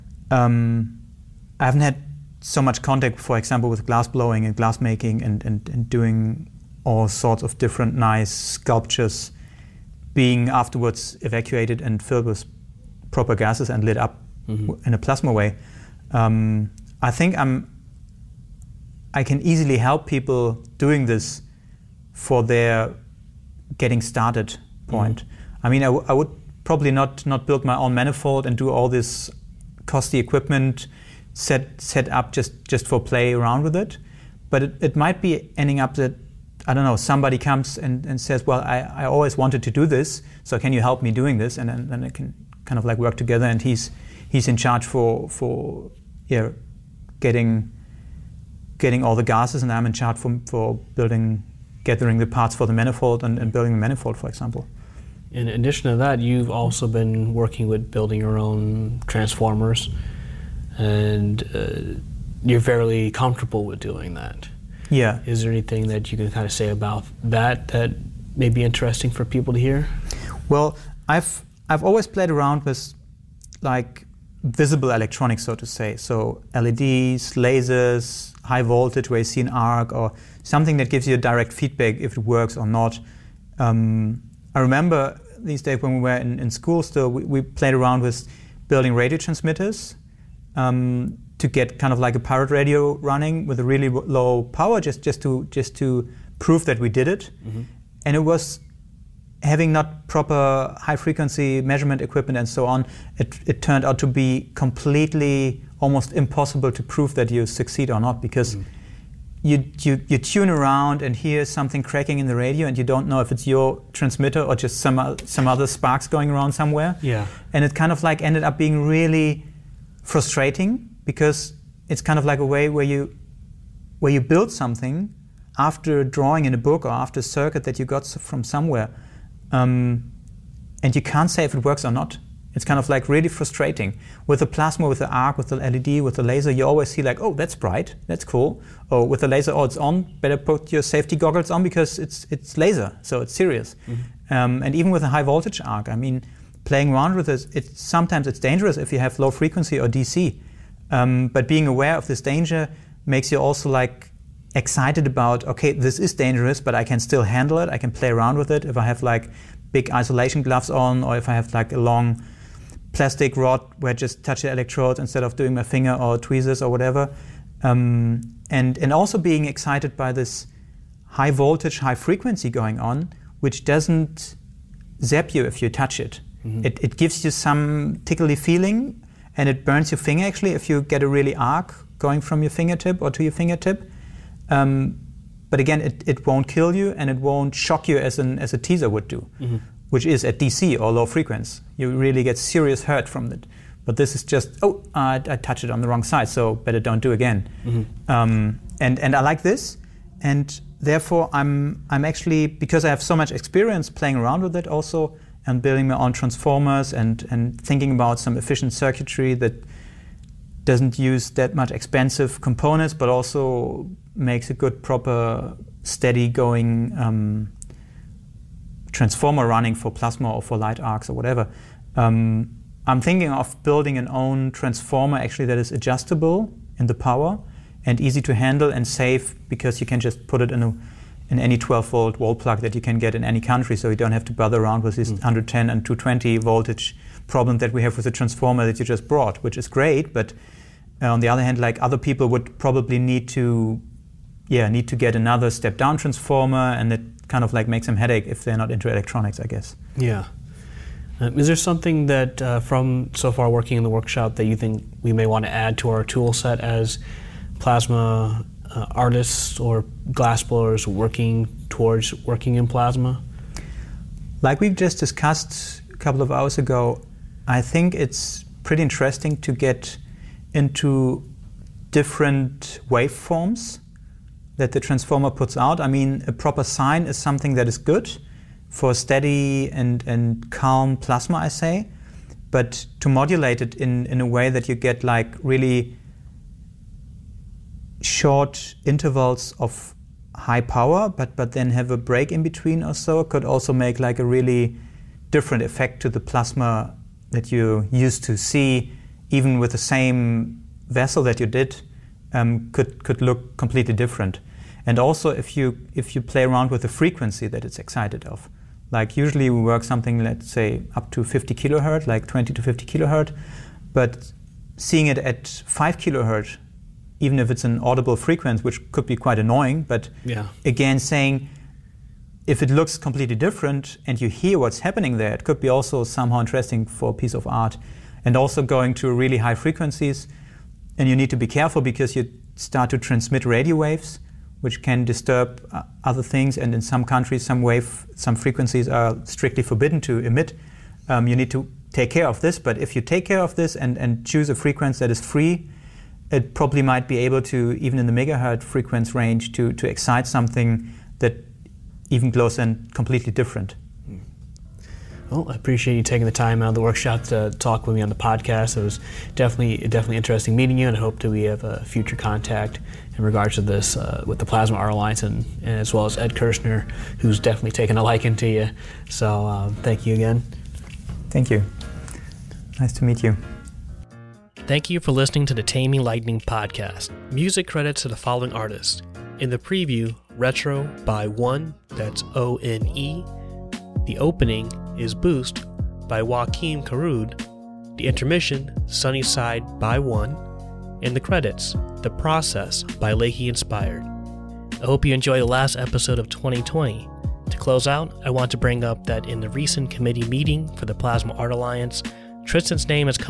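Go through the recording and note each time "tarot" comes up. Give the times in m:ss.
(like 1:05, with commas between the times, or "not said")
not said.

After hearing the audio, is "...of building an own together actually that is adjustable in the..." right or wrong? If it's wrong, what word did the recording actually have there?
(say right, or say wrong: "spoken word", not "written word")
wrong: "transformer", not "together".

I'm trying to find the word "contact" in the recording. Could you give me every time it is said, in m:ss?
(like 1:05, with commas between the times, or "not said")
0:02, 6:02.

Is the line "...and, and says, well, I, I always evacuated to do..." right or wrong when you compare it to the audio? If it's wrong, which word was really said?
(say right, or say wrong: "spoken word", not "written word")
wrong: "wanted", not "evacuated".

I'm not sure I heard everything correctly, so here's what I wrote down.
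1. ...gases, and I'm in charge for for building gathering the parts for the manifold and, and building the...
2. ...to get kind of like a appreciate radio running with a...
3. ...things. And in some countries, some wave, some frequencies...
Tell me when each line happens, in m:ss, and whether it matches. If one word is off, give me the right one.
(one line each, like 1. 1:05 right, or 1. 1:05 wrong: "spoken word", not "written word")
1. 0:49 right
2. 1:31 wrong: "pirate", not "appreciate"
3. 5:36 right.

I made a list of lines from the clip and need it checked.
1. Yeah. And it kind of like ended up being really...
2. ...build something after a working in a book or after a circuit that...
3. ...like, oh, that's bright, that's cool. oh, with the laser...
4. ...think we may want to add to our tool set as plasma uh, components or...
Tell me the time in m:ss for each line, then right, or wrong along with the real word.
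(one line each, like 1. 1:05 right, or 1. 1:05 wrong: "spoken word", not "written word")
1. 1:57 right
2. 2:04 wrong: "drawing", not "working"
3. 2:17 right
4. 4:14 wrong: "artists", not "components".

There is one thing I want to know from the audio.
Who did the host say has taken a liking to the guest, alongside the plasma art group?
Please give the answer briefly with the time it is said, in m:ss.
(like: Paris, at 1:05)
Ed Kirshner, at 6:06.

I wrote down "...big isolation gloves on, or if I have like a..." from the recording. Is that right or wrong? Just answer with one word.
right.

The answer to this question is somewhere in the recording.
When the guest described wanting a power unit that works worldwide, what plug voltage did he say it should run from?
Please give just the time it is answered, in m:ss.
3:51.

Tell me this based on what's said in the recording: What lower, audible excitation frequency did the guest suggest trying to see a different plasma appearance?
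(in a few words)
5 kilohertz.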